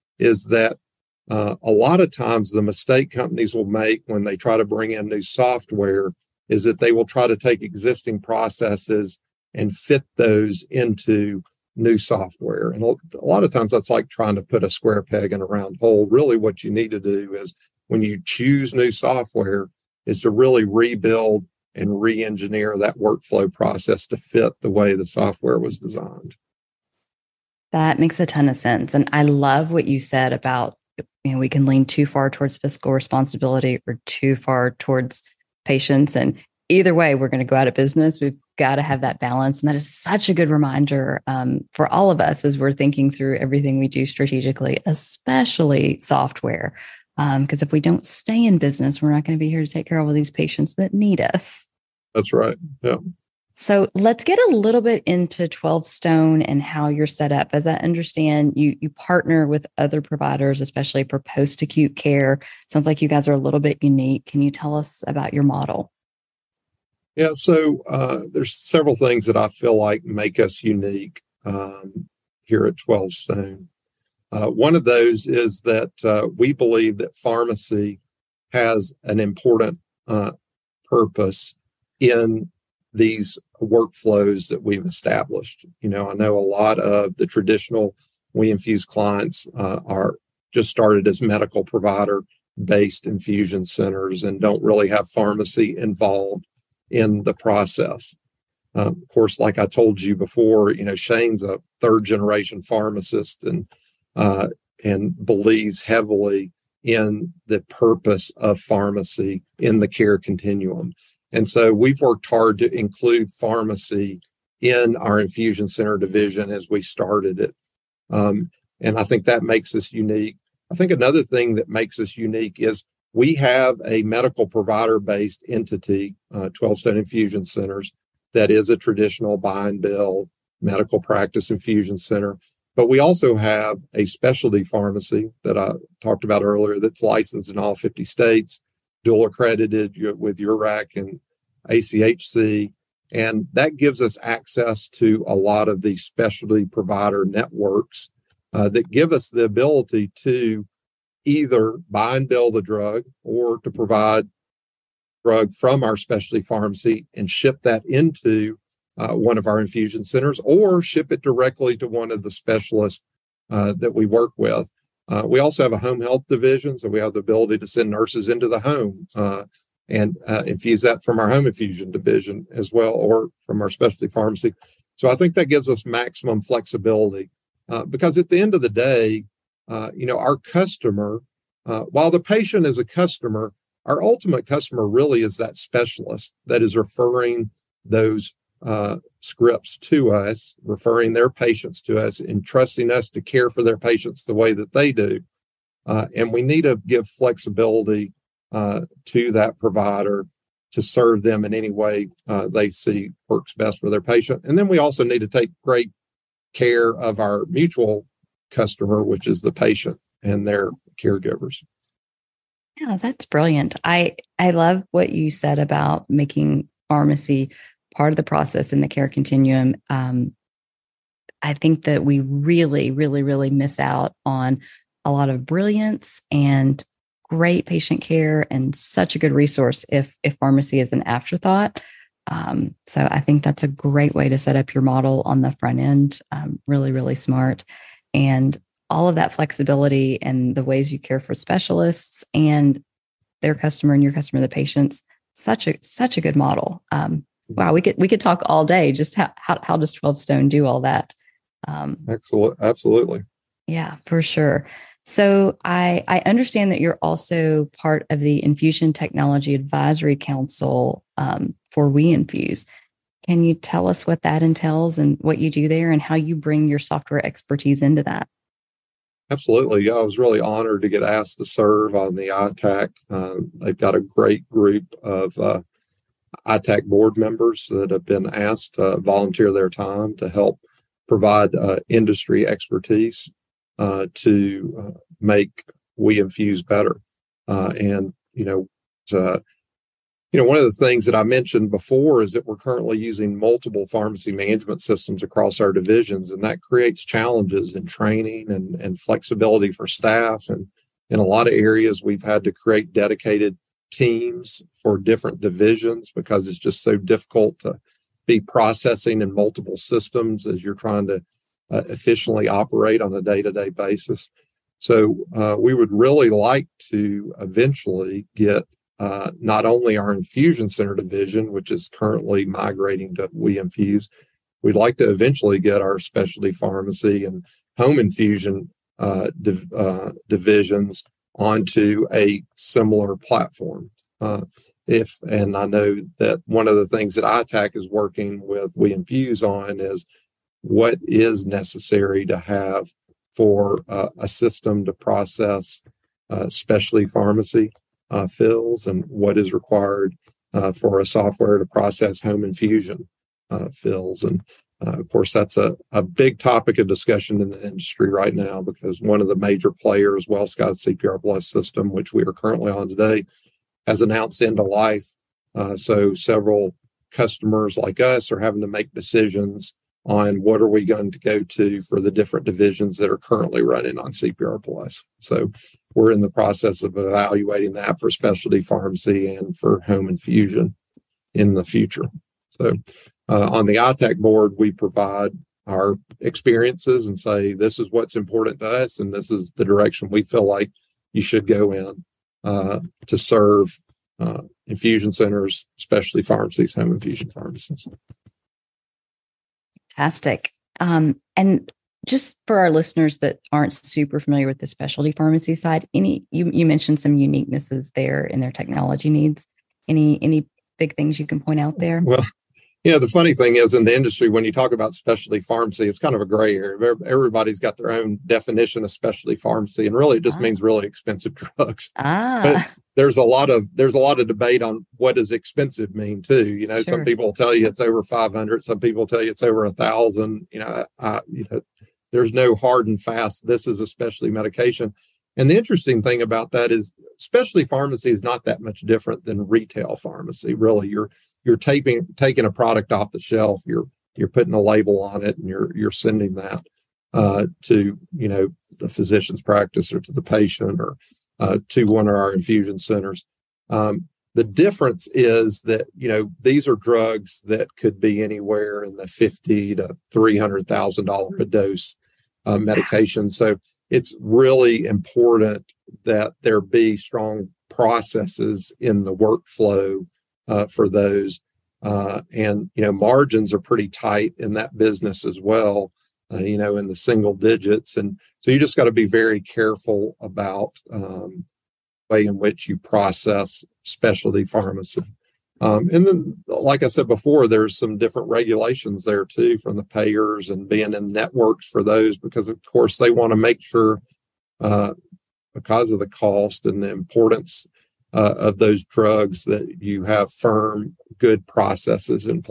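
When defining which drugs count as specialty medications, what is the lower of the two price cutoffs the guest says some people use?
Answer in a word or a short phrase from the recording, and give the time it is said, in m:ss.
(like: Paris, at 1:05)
500, at 7:08.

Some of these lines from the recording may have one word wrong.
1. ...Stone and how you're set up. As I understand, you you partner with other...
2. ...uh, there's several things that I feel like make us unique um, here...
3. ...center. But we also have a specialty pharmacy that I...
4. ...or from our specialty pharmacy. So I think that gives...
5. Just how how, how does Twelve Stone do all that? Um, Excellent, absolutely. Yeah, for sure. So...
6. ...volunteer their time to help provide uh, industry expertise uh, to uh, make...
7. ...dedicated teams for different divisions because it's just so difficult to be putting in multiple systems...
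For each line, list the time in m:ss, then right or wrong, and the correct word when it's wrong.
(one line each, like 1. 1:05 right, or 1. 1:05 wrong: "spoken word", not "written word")
1. 0:55 right
2. 1:07 right
3. 2:11 right
4. 2:52 right
5. 4:08 right
6. 4:38 right
7. 5:02 wrong: "processing", not "putting".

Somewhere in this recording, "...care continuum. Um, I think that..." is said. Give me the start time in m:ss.
3:38.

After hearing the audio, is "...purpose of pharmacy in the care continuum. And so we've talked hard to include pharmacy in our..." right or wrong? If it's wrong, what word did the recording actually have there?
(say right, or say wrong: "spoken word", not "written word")
wrong: "worked", not "talked".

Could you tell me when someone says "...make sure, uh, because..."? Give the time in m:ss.
8:13.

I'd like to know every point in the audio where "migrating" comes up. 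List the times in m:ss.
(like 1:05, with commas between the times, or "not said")
5:22.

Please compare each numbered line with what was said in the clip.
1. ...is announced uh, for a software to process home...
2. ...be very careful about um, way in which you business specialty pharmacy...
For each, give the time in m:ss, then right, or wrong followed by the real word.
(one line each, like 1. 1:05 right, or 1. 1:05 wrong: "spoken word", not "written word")
1. 5:49 wrong: "required", not "announced"
2. 7:58 wrong: "process", not "business".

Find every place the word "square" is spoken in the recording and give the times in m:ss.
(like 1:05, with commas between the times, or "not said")
0:14.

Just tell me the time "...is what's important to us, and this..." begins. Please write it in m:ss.
6:27.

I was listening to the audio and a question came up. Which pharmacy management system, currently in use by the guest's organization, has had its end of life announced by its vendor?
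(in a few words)
WellSky CPR Plus.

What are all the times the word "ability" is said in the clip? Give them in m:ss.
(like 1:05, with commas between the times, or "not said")
2:29, 2:47.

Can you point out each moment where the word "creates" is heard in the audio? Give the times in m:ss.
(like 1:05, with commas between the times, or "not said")
4:56, 5:02.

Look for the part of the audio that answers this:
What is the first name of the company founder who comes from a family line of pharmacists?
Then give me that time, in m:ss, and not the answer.
1:40.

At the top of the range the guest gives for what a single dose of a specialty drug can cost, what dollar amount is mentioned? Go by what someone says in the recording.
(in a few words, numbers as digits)
$300,000.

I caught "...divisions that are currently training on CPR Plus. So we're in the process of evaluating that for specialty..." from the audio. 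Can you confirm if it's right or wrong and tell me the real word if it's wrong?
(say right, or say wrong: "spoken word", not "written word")
wrong: "running", not "training".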